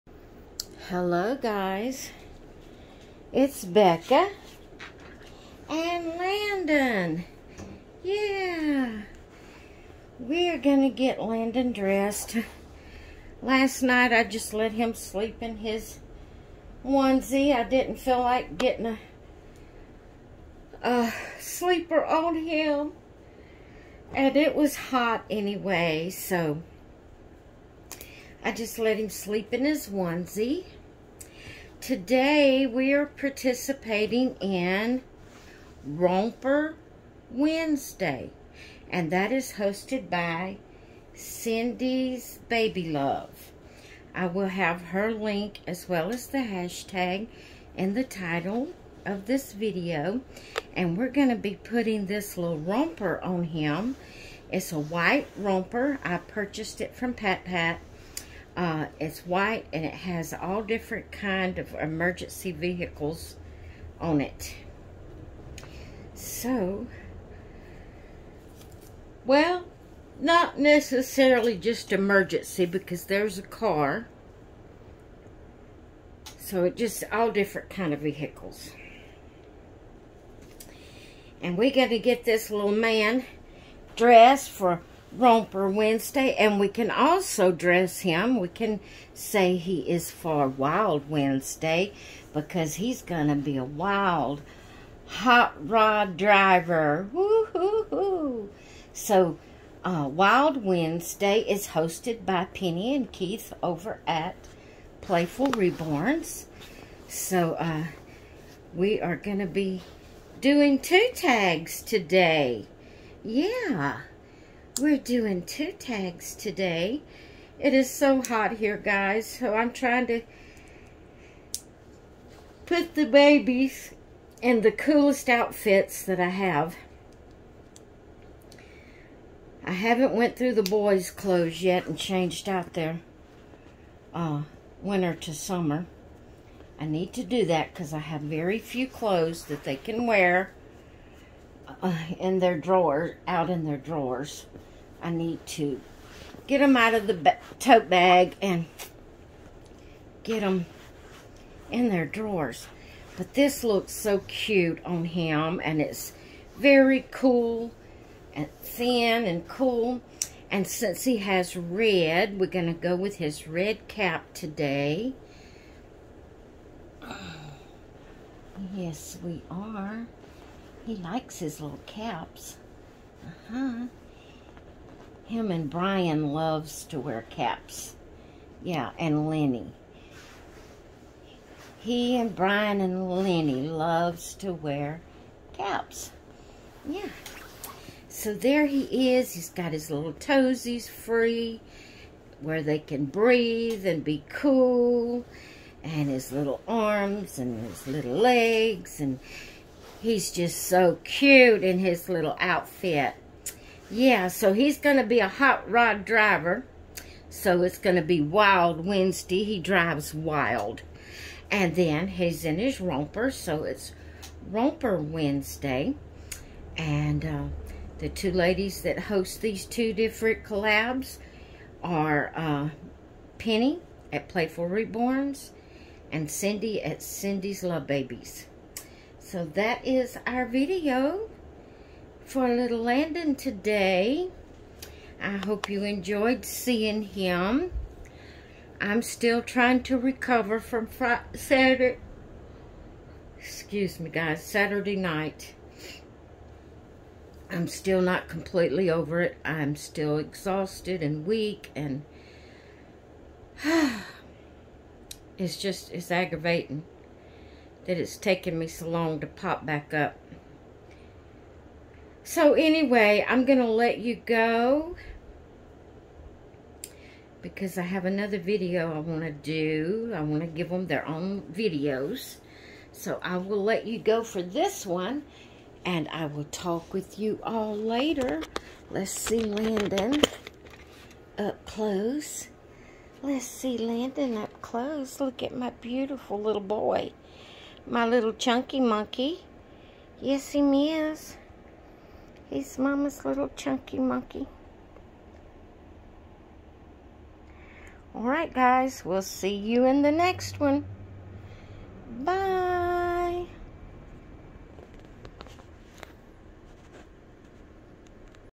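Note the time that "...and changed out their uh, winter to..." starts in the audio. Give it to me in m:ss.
2:11.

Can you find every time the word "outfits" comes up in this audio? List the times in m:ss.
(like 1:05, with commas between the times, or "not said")
2:05, 3:22.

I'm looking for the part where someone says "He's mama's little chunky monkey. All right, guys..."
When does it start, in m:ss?
4:52.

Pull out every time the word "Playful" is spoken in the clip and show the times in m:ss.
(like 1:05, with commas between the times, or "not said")
1:45, 3:44.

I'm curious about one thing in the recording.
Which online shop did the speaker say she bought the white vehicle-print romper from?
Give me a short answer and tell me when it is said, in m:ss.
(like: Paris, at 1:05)
PatPat, at 0:57.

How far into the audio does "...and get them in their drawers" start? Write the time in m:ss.
2:28.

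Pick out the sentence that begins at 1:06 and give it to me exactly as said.
So, well, not necessarily just emergency because there's a car.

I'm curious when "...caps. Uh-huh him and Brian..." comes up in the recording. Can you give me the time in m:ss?
2:51.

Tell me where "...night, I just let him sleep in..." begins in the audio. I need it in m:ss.
0:13.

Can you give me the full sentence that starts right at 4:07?
I'm still not completely over it.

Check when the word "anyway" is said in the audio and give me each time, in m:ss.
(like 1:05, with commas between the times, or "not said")
0:25, 4:22.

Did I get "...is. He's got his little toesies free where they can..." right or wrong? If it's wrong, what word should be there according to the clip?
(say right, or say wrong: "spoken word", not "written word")
right.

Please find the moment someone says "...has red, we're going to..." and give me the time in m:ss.
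2:41.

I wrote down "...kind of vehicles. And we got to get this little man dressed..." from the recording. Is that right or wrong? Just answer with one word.
right.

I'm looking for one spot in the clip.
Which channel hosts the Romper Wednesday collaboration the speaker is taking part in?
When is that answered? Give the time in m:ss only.
0:41.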